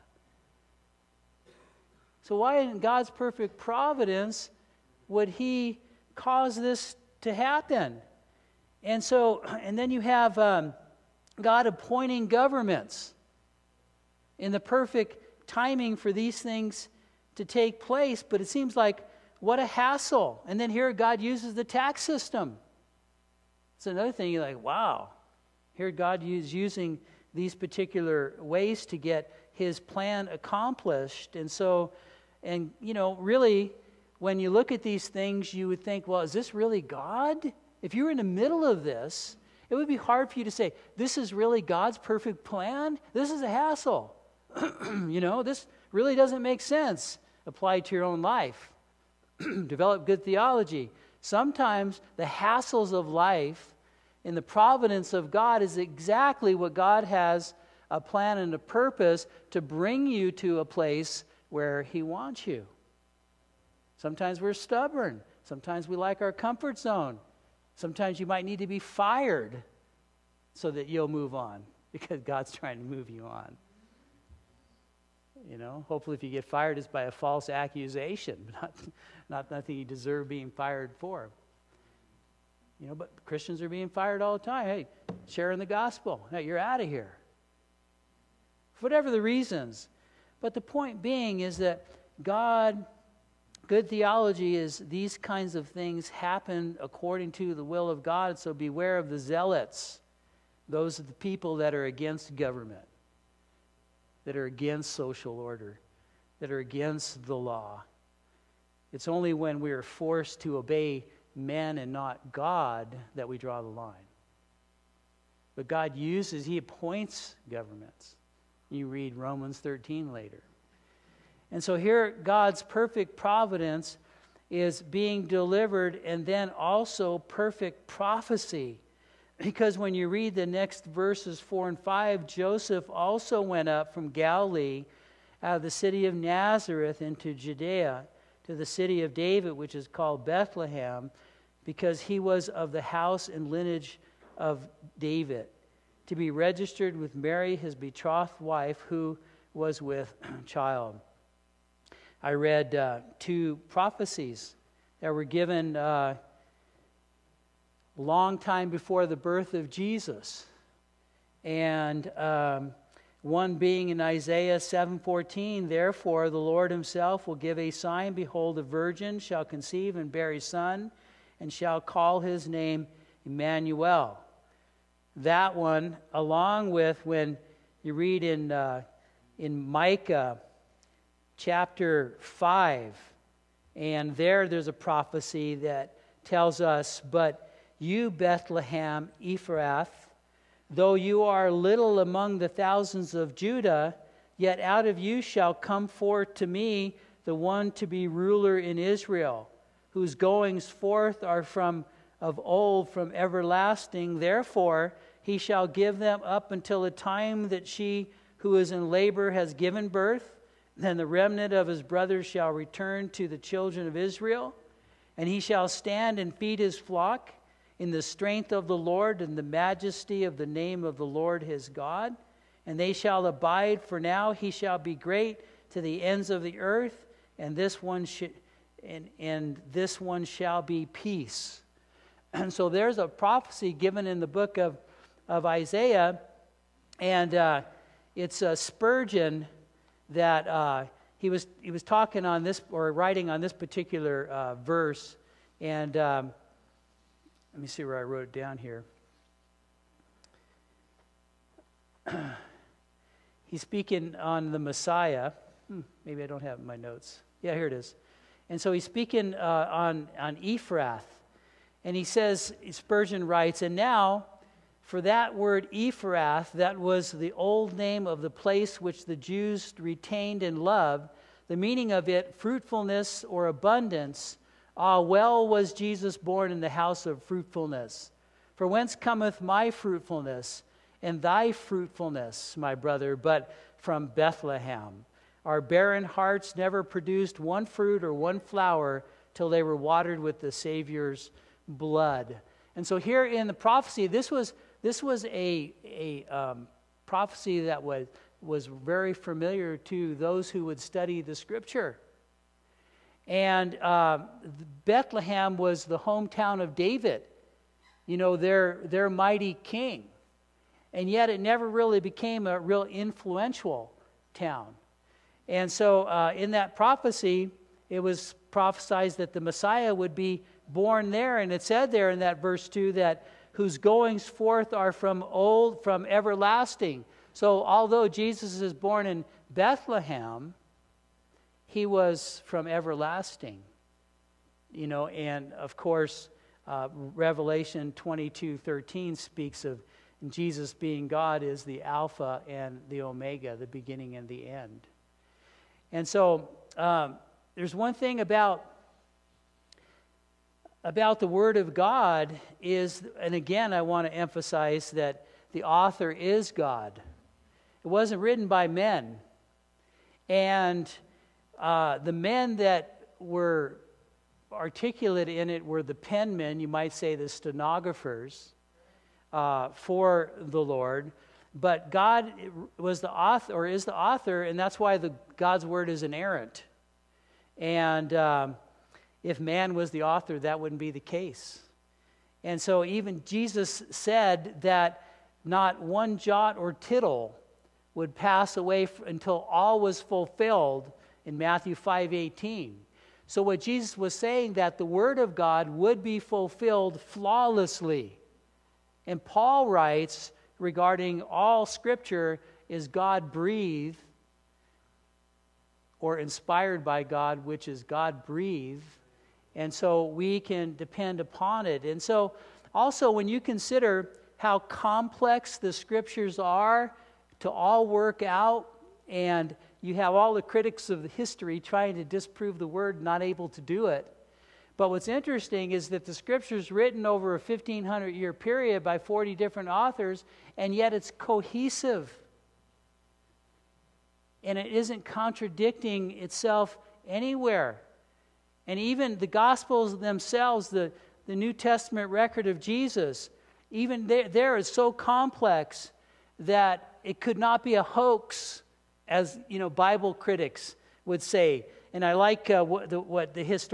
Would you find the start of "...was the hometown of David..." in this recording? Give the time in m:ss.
5:05.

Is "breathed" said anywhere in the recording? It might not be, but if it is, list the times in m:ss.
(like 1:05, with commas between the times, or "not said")
6:43, 6:48.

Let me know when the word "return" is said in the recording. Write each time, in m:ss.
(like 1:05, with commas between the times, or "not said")
3:32.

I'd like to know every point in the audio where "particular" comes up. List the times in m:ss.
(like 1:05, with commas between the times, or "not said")
0:27, 4:03.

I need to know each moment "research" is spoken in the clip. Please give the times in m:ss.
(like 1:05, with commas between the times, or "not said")
not said.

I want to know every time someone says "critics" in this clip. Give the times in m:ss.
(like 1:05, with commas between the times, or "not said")
7:00, 7:30.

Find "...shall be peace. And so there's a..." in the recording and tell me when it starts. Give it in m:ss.
3:50.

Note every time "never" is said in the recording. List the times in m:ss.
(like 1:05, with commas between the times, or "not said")
4:46, 5:11.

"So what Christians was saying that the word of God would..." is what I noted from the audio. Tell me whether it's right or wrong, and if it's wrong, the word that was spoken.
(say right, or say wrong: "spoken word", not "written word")
wrong: "Jesus", not "Christians".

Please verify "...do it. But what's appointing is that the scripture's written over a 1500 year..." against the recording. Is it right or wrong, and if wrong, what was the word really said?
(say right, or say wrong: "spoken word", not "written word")
wrong: "interesting", not "appointing".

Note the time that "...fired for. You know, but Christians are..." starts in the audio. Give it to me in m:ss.
1:20.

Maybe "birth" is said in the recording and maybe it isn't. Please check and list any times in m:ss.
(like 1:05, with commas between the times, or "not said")
2:39, 3:29.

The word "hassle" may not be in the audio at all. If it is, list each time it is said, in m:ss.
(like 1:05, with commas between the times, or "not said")
0:19, 0:43, 0:52.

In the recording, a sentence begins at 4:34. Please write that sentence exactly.
Ah, well was Jesus born in the house of fruitfulness.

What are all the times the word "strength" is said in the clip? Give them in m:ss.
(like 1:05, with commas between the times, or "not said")
3:38.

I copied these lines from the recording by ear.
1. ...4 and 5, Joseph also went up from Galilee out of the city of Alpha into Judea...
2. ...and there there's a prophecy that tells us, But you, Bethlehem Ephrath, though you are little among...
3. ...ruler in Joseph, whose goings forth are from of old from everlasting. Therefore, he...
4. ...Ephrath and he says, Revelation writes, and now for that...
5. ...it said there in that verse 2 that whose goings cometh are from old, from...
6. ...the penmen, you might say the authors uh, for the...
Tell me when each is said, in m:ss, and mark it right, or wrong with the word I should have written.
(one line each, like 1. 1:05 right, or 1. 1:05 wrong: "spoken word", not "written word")
1. 2:11 wrong: "Nazareth", not "Alpha"
2. 3:03 right
3. 3:18 wrong: "Israel", not "Joseph"
4. 4:20 wrong: "Spurgeon", not "Revelation"
5. 5:21 wrong: "forth", not "cometh"
6. 6:05 wrong: "stenographers", not "authors".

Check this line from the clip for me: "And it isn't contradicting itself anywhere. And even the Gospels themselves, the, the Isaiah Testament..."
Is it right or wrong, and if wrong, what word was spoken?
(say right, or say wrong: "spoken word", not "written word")
wrong: "New", not "Isaiah".